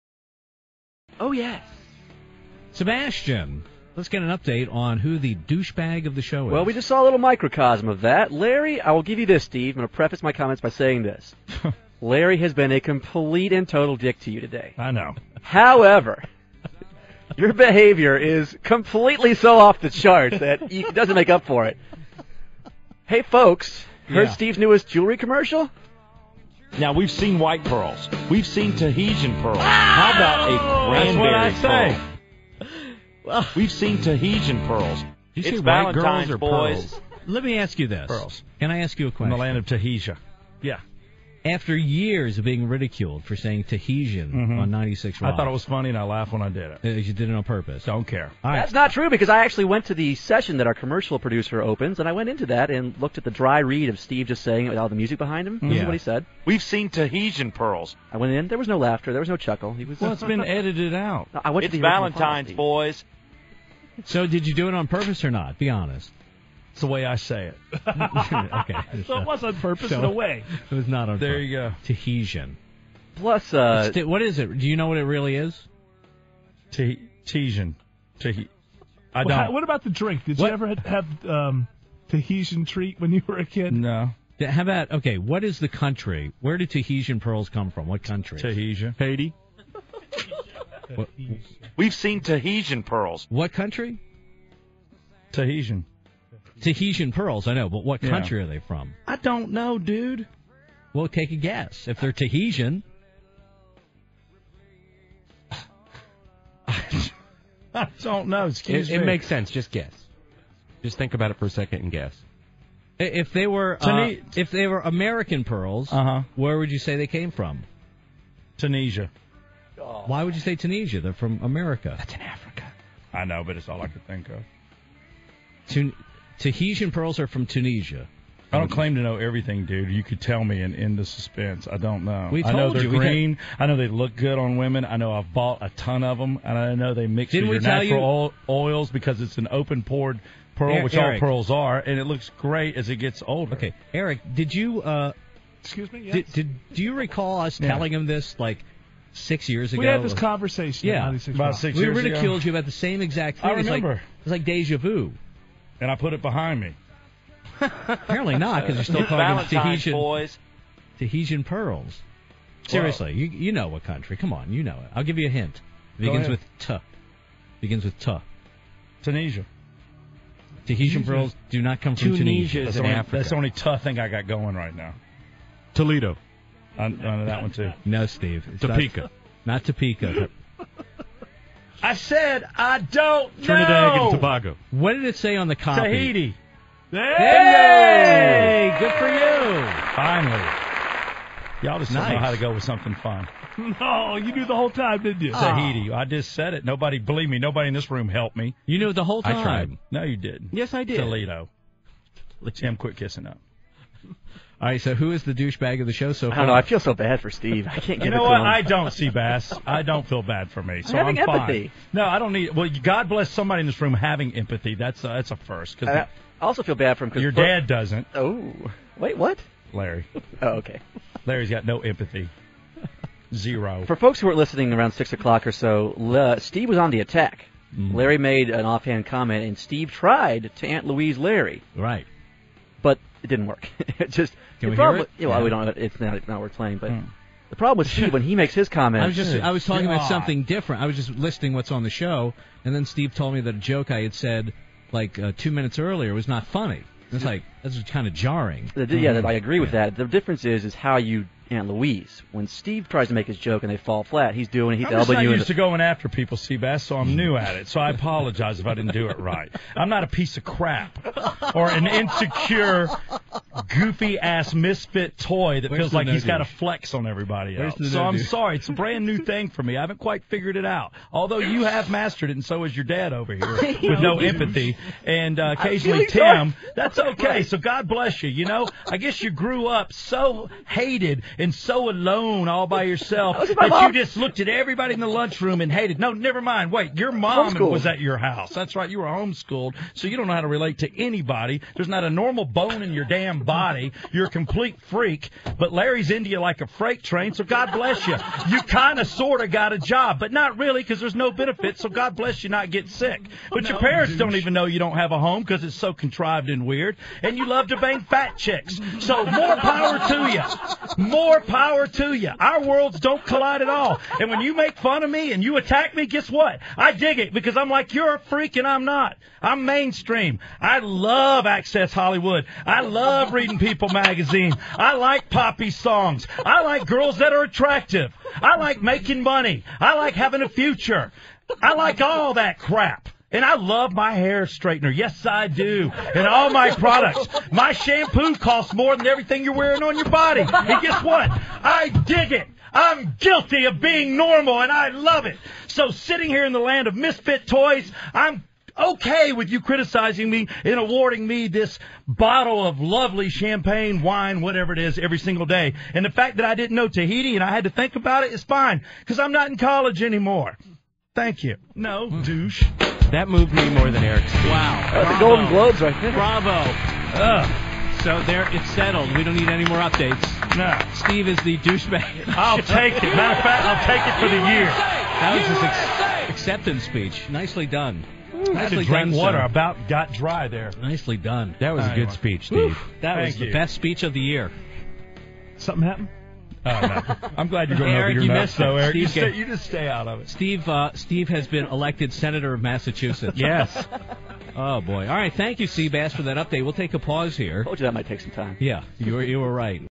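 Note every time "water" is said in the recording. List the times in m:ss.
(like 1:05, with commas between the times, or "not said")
6:19.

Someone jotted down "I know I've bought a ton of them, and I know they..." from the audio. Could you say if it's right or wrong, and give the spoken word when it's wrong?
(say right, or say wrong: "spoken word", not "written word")
right.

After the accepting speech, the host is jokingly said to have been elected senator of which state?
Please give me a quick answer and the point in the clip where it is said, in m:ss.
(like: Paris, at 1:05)
Massachusetts, at 6:32.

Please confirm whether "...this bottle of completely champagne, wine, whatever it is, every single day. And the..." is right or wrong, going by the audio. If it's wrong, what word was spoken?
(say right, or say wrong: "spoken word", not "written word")
wrong: "lovely", not "completely".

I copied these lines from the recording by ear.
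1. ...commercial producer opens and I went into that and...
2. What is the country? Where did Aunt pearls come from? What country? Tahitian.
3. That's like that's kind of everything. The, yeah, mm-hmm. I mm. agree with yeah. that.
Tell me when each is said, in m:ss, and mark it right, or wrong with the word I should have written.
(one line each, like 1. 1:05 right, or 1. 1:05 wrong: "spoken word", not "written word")
1. 0:50 right
2. 1:25 wrong: "Tahitian", not "Aunt"
3. 4:07 wrong: "jarring", not "everything".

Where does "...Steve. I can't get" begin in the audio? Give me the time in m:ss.
3:27.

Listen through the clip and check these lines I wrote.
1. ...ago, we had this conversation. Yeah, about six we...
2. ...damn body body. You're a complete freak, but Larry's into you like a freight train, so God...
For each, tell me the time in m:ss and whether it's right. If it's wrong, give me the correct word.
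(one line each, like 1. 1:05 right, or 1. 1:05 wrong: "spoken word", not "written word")
1. 2:29 right
2. 4:53 right.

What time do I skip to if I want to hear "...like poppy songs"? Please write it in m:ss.
5:24.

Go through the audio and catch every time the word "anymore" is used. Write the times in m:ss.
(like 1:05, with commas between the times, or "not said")
6:00.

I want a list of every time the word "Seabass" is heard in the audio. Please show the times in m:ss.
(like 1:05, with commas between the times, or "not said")
4:16, 6:35.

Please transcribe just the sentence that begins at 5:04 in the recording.
don't even know you don't have a home because it's so contrived and weird, and you love to bang fat chicks.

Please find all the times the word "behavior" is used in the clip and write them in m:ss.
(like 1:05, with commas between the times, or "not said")
0:17.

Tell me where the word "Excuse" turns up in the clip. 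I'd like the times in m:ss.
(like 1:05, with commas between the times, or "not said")
1:48, 2:25.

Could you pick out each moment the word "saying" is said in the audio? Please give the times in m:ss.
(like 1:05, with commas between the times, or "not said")
0:10, 0:43, 0:54.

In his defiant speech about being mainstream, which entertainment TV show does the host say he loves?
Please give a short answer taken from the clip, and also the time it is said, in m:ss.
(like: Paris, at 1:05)
Access Hollywood, at 5:21.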